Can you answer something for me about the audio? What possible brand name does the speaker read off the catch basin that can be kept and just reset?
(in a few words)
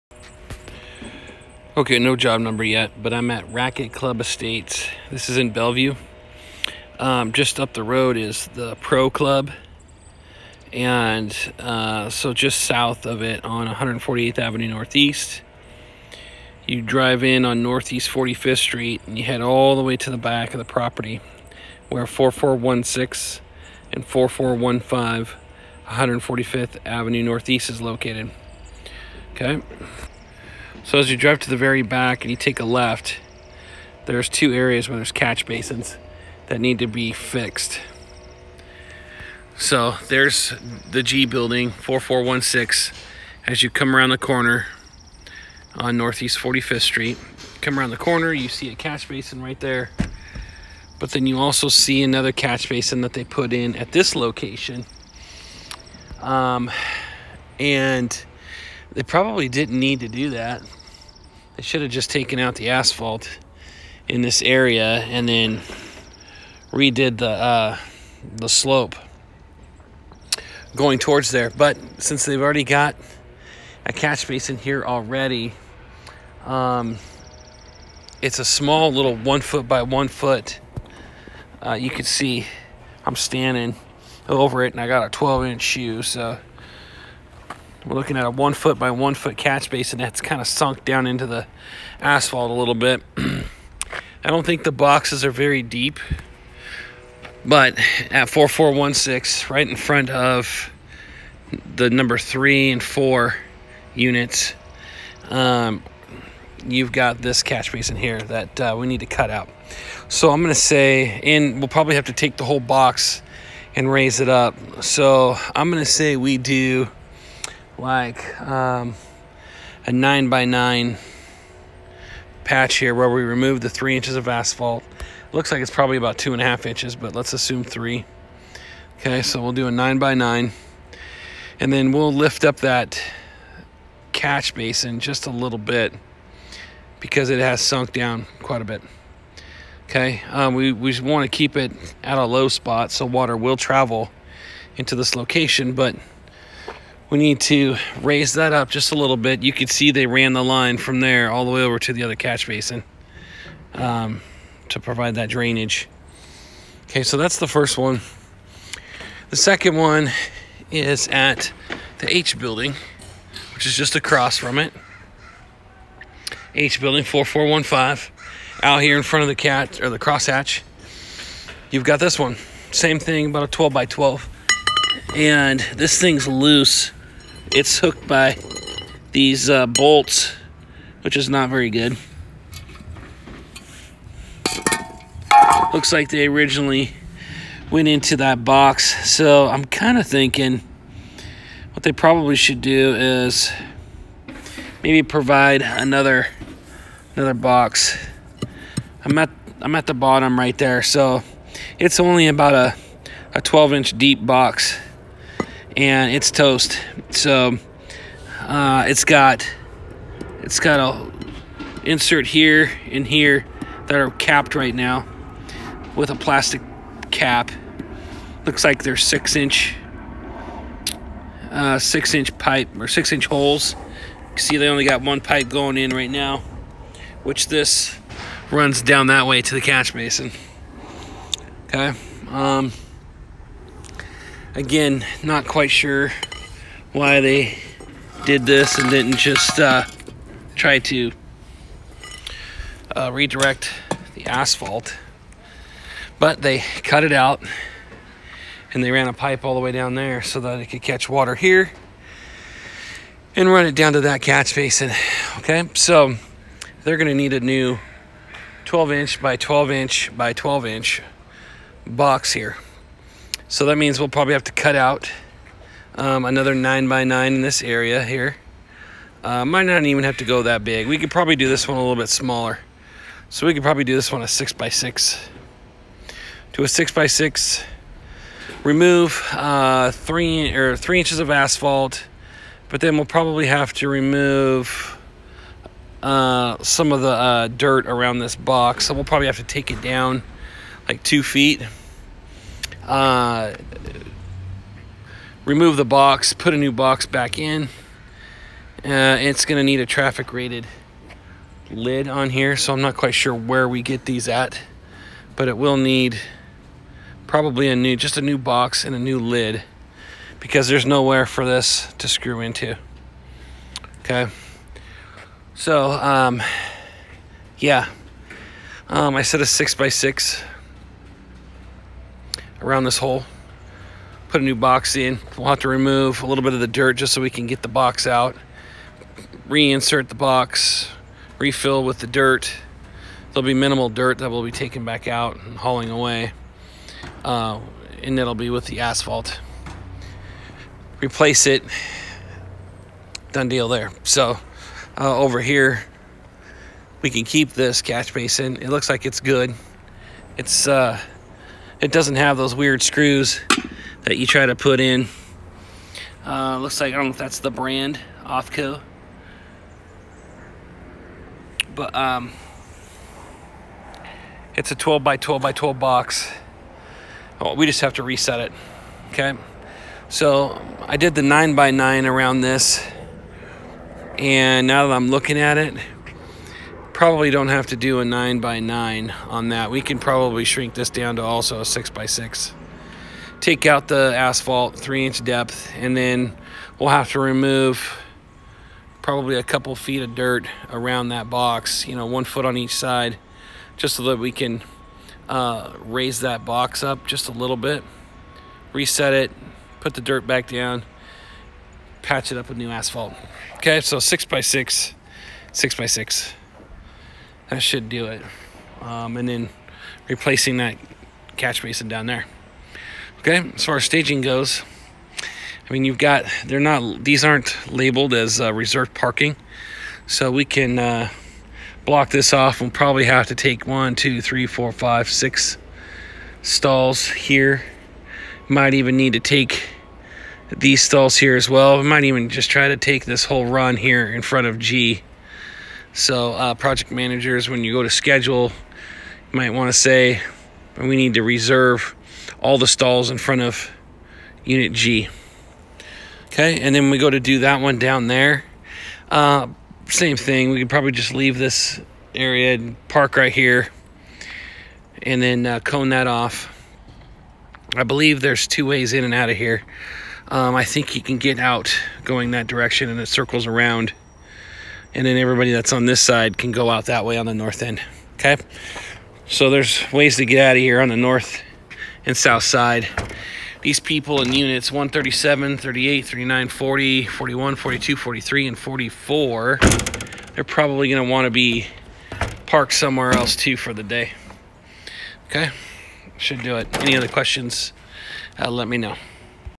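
Offco.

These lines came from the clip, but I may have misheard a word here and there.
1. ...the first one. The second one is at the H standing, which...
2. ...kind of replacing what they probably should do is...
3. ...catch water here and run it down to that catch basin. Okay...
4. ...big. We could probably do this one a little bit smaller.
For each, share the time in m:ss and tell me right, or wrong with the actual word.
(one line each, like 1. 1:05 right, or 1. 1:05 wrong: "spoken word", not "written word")
1. 2:37 wrong: "building", not "standing"
2. 3:09 wrong: "thinking", not "replacing"
3. 4:10 right
4. 4:30 right.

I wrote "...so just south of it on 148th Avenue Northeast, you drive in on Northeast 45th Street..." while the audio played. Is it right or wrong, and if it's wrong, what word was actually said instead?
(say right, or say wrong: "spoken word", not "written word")
right.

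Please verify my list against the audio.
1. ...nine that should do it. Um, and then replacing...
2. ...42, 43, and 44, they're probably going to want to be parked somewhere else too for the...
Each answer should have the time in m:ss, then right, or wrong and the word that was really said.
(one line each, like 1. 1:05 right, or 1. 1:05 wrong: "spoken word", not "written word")
1. 6:45 wrong: "six", not "nine"
2. 7:57 right.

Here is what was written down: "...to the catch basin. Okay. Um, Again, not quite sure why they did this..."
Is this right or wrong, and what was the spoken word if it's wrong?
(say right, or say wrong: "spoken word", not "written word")
right.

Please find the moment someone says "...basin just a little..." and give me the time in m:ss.
2:14.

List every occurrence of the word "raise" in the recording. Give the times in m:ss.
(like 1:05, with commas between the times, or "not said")
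1:53, 2:28, 6:35.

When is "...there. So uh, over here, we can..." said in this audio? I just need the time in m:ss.
5:43.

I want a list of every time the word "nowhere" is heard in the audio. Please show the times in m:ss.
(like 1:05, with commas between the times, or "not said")
5:10.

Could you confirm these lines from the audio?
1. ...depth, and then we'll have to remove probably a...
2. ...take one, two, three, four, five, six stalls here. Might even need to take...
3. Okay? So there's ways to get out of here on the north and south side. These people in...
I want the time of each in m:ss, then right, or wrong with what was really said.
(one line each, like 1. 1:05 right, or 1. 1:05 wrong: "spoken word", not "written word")
1. 6:25 right
2. 7:03 right
3. 7:48 right.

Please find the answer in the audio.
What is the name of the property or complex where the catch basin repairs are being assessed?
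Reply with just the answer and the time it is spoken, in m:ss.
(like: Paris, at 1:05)
Racquet Club Estates, at 0:03.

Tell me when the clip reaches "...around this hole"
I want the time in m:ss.
5:22.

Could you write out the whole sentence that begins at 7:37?
I believe there's two ways in and out of here.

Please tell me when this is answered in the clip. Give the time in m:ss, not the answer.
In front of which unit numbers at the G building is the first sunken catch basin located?
1:41.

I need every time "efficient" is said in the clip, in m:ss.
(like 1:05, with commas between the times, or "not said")
not said.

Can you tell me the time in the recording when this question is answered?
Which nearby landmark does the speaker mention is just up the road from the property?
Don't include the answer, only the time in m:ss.
0:08.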